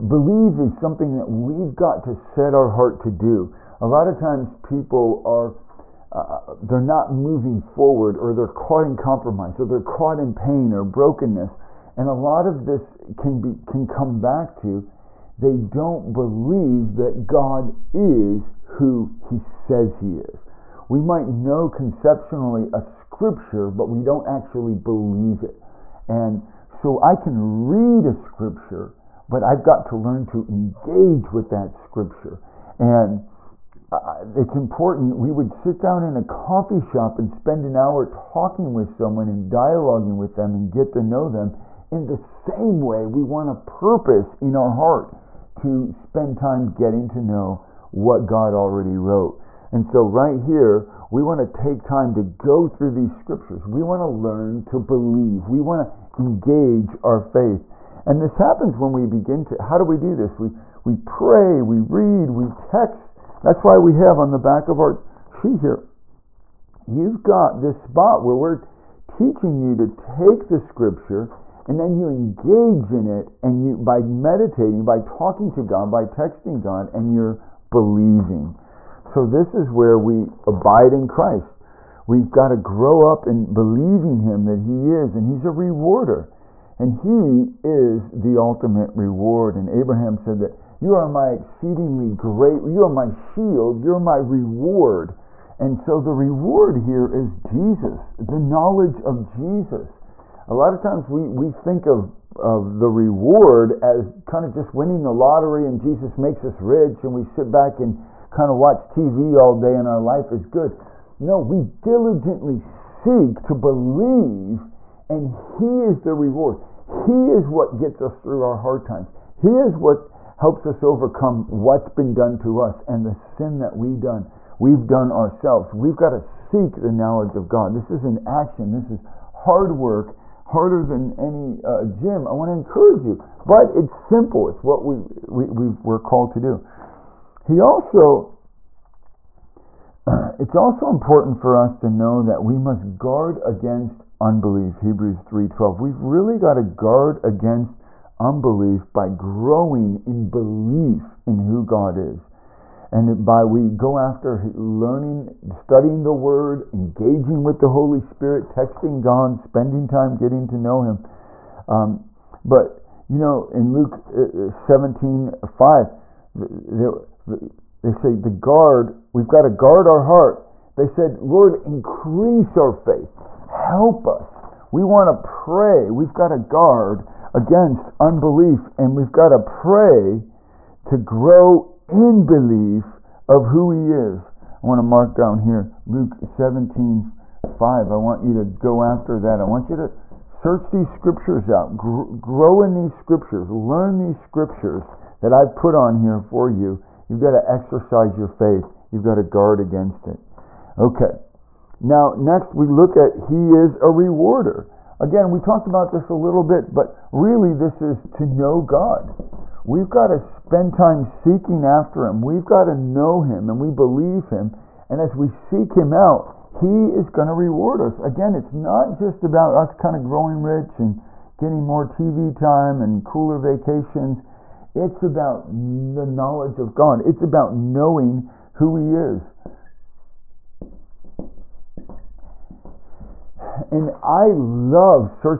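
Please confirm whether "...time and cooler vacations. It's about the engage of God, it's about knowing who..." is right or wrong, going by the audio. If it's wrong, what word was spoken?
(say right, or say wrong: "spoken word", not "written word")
wrong: "knowledge", not "engage".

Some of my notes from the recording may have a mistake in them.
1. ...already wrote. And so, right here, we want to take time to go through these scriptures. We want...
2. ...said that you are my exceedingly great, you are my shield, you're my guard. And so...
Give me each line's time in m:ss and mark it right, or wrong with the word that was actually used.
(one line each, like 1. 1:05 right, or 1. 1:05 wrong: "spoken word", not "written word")
1. 0:48 right
2. 1:30 wrong: "reward", not "guard".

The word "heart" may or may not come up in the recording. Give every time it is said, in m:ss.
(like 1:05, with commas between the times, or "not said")
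0:02, 0:44, 2:50.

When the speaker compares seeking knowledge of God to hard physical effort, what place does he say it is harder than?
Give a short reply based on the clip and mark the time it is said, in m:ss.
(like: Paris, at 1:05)
Gym, at 2:11.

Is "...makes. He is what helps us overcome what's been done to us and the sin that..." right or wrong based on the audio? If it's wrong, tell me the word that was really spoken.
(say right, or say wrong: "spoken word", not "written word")
wrong: "times", not "makes".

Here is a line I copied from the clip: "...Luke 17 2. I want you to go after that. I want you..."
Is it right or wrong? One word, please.
wrong.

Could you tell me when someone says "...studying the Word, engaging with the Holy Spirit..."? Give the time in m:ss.
2:35.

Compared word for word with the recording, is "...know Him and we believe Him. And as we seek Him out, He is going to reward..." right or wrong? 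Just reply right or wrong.
right.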